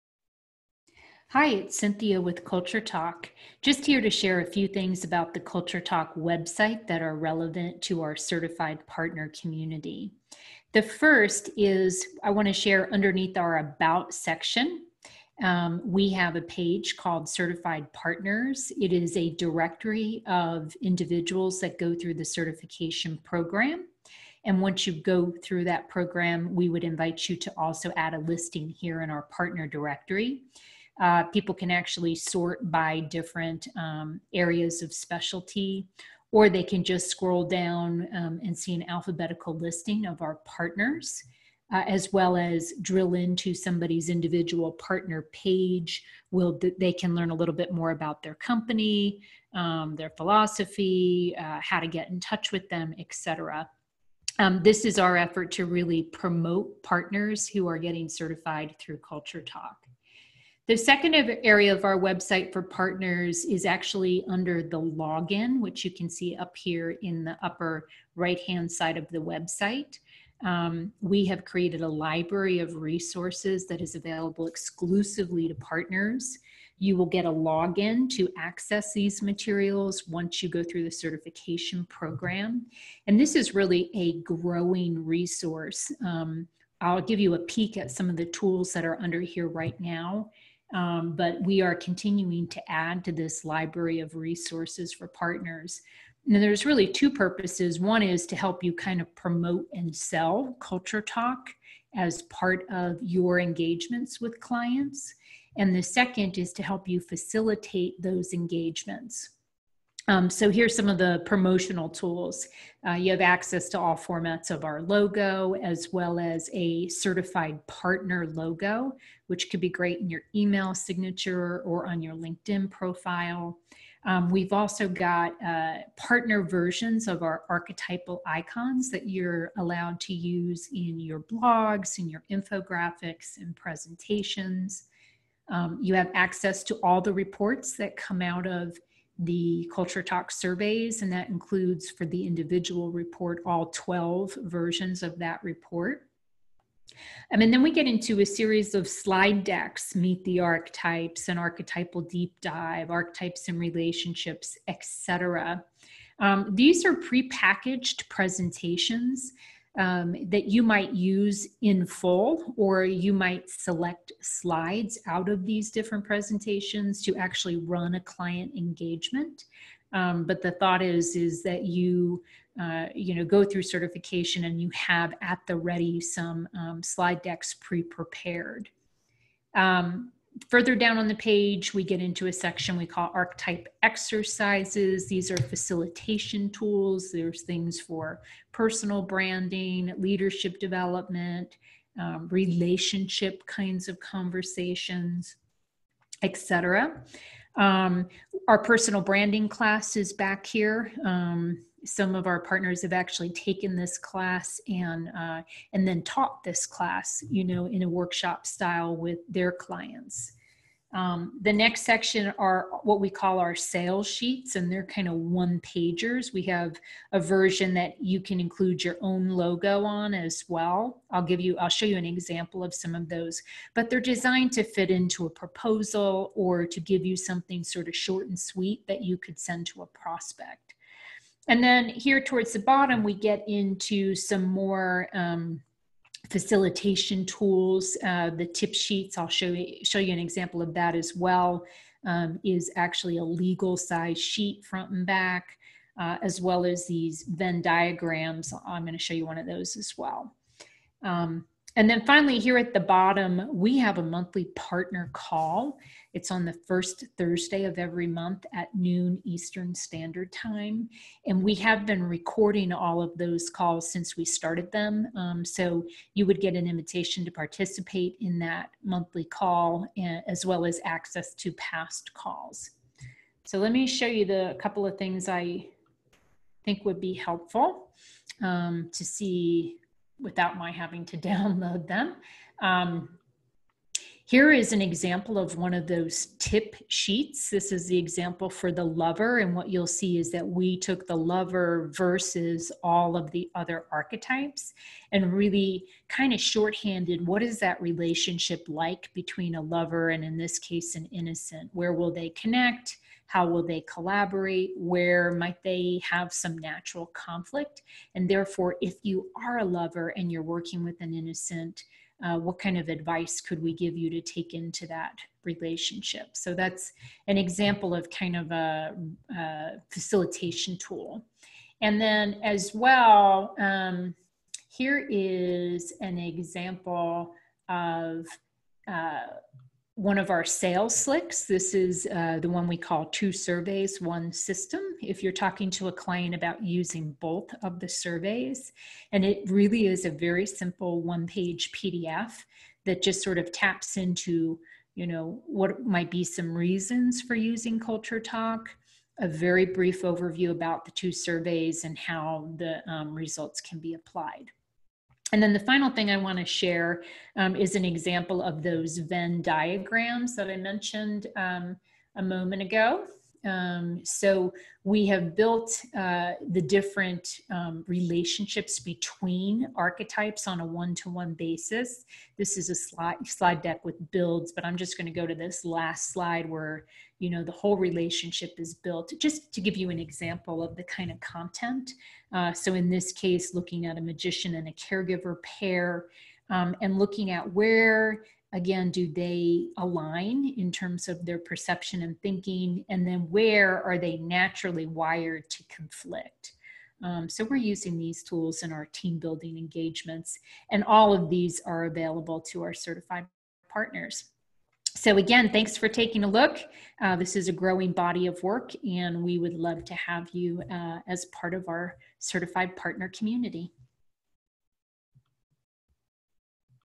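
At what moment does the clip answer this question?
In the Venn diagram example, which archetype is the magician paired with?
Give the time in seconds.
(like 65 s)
384 s.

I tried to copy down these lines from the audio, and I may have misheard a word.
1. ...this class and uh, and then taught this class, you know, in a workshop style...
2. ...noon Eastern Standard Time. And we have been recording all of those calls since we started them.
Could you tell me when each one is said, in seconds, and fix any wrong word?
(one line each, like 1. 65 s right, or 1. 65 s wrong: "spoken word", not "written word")
1. 203 s right
2. 258 s right.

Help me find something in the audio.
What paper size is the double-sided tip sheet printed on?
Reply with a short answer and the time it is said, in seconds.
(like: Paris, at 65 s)
Legal size, at 243 s.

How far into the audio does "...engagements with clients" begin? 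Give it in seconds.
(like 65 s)
103 s.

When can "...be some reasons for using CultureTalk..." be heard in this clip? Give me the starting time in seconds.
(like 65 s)
346 s.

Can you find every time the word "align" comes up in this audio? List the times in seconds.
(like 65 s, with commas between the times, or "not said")
389 s.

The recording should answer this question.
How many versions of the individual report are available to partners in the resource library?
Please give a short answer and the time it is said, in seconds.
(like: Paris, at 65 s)
12, at 143 s.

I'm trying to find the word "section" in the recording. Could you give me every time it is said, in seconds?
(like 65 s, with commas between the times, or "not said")
14 s, 182 s, 211 s.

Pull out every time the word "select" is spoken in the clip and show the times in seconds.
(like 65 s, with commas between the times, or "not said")
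163 s.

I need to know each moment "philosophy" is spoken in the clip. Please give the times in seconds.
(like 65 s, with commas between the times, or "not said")
50 s.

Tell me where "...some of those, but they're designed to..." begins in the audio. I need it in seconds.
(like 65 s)
222 s.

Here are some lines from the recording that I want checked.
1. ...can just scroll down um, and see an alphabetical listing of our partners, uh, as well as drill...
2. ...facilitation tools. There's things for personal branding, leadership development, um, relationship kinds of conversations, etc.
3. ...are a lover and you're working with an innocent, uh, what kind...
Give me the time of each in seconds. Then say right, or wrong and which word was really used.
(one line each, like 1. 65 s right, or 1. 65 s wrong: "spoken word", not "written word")
1. 36 s right
2. 185 s right
3. 309 s right.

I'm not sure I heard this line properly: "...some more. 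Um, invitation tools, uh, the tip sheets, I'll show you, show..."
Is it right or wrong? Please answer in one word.
wrong.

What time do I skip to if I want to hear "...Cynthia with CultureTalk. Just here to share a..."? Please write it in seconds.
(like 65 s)
1 s.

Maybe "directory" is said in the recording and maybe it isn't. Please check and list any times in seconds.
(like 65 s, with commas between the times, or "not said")
19 s, 29 s.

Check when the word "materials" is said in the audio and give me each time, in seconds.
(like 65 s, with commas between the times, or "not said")
79 s.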